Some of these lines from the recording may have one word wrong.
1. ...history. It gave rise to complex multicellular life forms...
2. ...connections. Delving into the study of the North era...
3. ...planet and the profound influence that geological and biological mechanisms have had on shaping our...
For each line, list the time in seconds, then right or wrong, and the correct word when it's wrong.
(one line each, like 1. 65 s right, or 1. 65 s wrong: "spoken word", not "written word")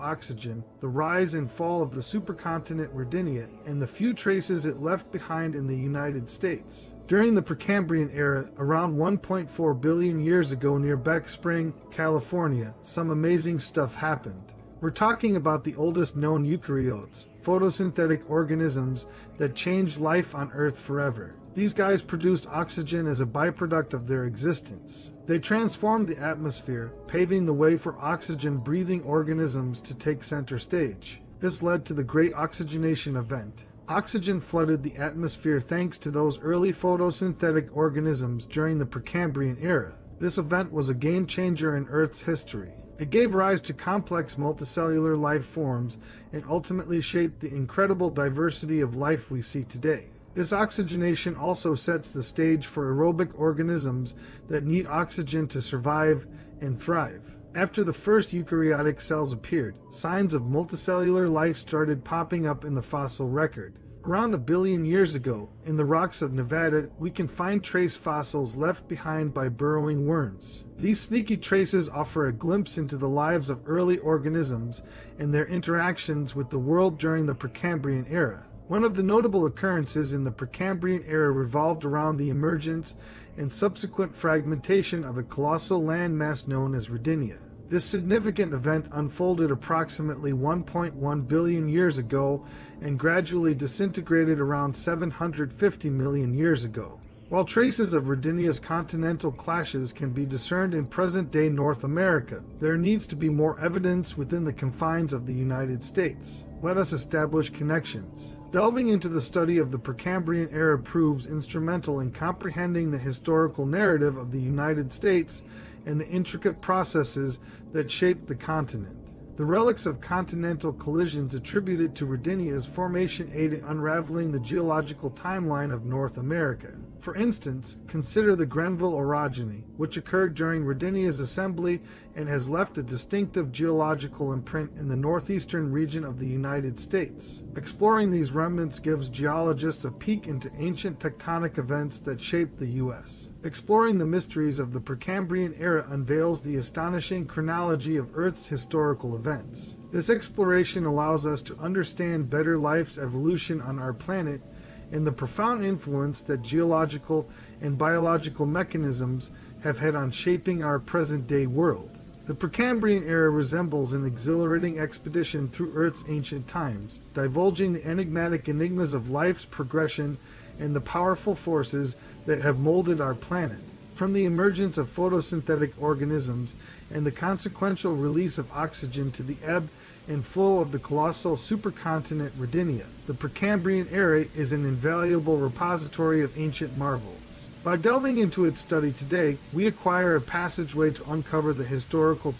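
1. 42 s right
2. 107 s wrong: "Precambrian", not "North"
3. 153 s right.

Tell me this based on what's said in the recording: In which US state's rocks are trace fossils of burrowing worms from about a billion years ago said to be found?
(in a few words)
Nevada.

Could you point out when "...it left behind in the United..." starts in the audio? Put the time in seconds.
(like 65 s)
4 s.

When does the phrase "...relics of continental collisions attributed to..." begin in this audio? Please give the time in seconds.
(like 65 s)
119 s.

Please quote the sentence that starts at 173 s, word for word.
From the emergence of photosynthetic organisms and the consequential release of oxygen to the ebb and flow of the colossal supercontinent Rodinia.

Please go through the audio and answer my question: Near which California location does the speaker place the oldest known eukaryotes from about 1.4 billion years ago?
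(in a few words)
Beck Spring.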